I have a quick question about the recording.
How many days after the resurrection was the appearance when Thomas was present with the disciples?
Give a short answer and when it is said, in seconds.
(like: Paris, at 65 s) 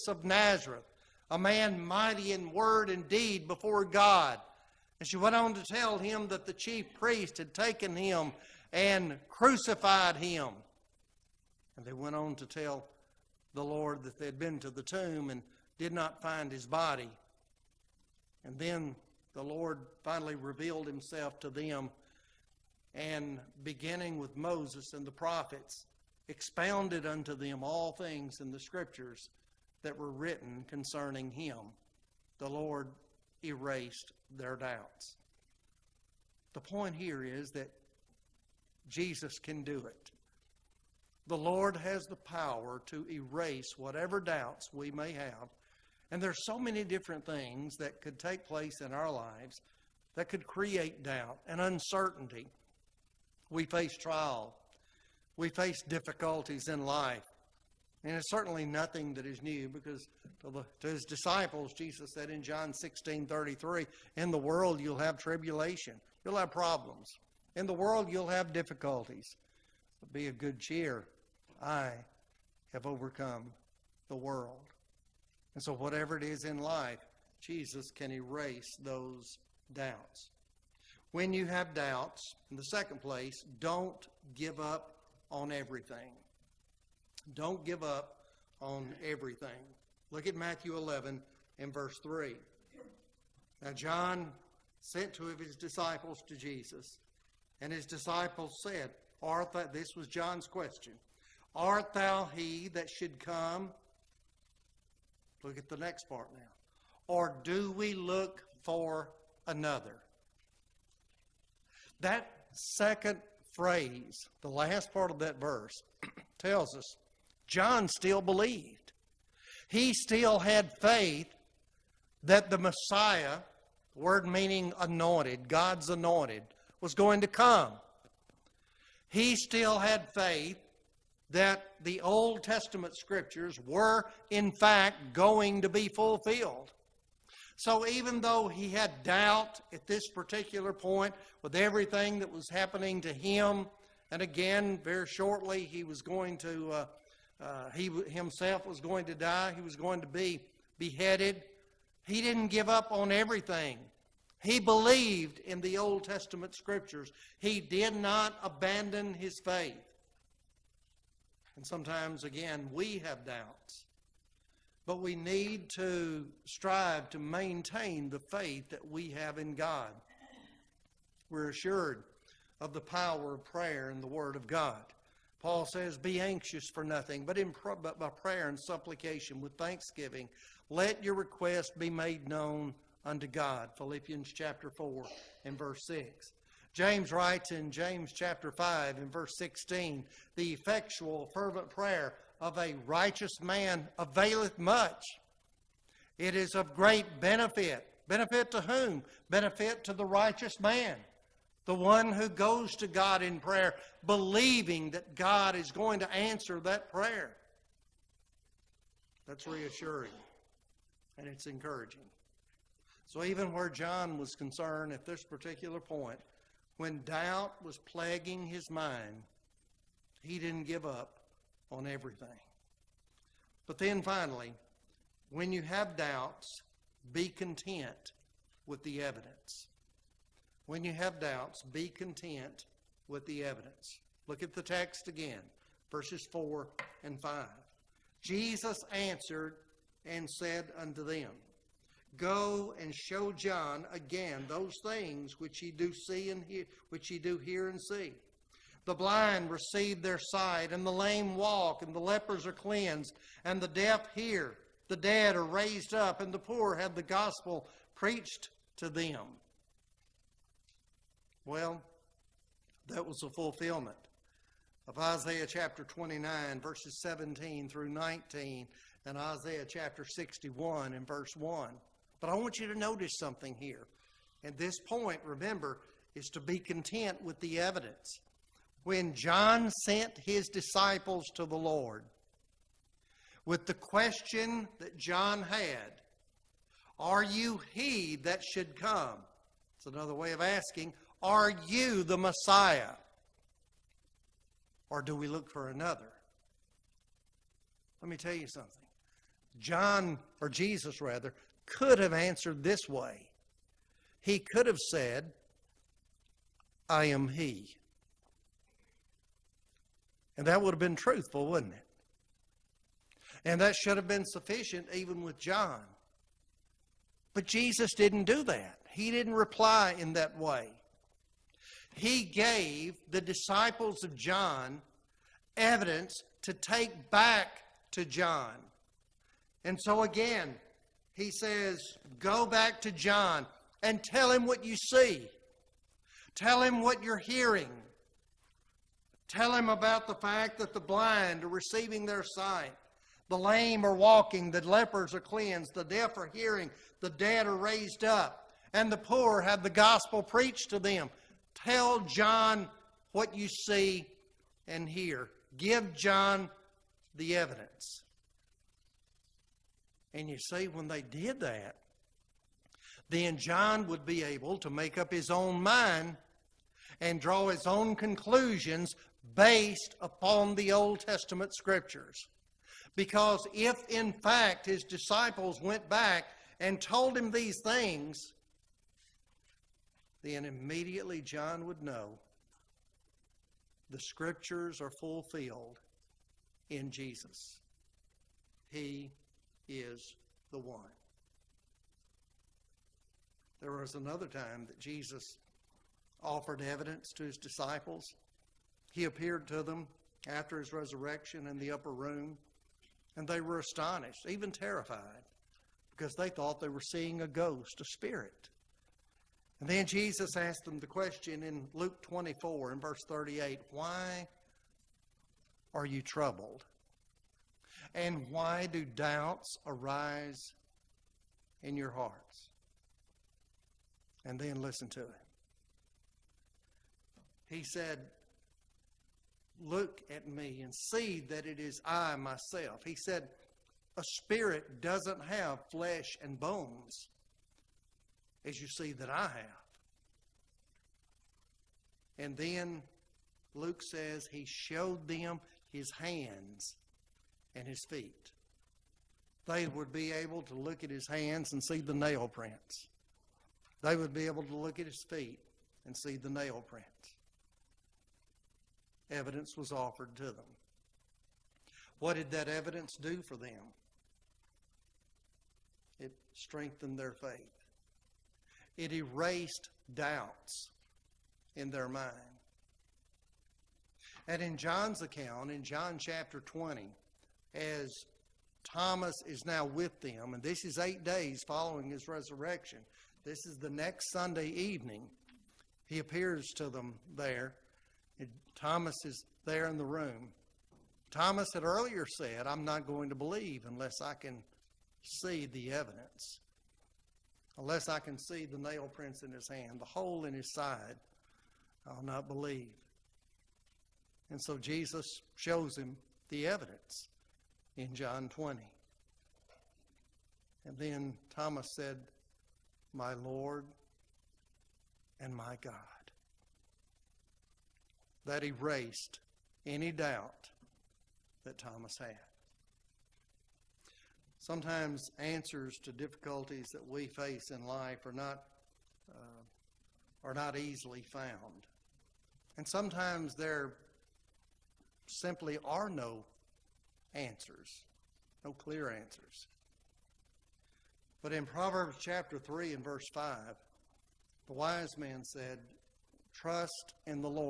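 8, at 480 s.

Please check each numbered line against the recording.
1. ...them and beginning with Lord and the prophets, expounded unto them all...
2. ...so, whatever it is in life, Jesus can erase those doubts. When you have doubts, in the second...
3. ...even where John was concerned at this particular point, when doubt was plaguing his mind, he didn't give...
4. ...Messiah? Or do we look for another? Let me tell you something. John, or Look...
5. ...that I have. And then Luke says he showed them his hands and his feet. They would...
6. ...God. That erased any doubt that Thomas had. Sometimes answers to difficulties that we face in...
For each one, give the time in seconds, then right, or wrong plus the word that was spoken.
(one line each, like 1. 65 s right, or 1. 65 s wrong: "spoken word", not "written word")
1. 21 s wrong: "Moses", not "Lord"
2. 75 s right
3. 213 s right
4. 292 s wrong: "Jesus", not "Look"
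5. 438 s right
6. 515 s right.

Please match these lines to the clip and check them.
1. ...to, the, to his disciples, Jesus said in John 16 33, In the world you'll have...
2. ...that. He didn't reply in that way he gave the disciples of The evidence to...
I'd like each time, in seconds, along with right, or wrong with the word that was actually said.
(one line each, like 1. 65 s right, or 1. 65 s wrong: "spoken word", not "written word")
1. 60 s right
2. 318 s wrong: "John", not "The".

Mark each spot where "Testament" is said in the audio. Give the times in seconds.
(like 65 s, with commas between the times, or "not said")
132 s, 156 s, 371 s.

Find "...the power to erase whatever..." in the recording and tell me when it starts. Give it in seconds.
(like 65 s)
42 s.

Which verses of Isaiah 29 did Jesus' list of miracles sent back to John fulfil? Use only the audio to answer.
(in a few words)
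17 through 19.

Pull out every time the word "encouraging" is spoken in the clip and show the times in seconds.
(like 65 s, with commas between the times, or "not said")
211 s.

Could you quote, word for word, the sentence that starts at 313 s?
And that should have been sufficient even with John.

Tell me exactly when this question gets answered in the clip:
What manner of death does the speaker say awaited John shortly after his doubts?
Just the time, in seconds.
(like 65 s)
150 s.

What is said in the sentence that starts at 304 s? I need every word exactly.
He could have said, I am He.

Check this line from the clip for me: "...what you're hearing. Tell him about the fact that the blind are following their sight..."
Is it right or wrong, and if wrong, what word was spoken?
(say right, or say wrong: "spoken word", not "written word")
wrong: "receiving", not "following".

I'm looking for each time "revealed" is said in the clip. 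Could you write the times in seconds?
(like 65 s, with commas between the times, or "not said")
20 s.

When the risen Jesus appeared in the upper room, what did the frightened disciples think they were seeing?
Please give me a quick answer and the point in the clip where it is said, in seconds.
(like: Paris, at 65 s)
A ghost, at 407 s.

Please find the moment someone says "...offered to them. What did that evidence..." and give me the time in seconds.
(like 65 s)
459 s.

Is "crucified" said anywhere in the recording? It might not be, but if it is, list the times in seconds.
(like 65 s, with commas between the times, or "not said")
9 s.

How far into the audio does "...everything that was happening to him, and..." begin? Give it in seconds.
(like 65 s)
141 s.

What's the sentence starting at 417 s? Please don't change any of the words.
And why do doubts arise in your hearts?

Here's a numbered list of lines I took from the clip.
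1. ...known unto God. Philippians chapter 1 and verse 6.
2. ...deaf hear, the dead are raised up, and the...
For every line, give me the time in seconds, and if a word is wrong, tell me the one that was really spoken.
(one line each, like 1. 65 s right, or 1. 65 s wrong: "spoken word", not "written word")
1. 182 s wrong: "4", not "1"
2. 253 s right.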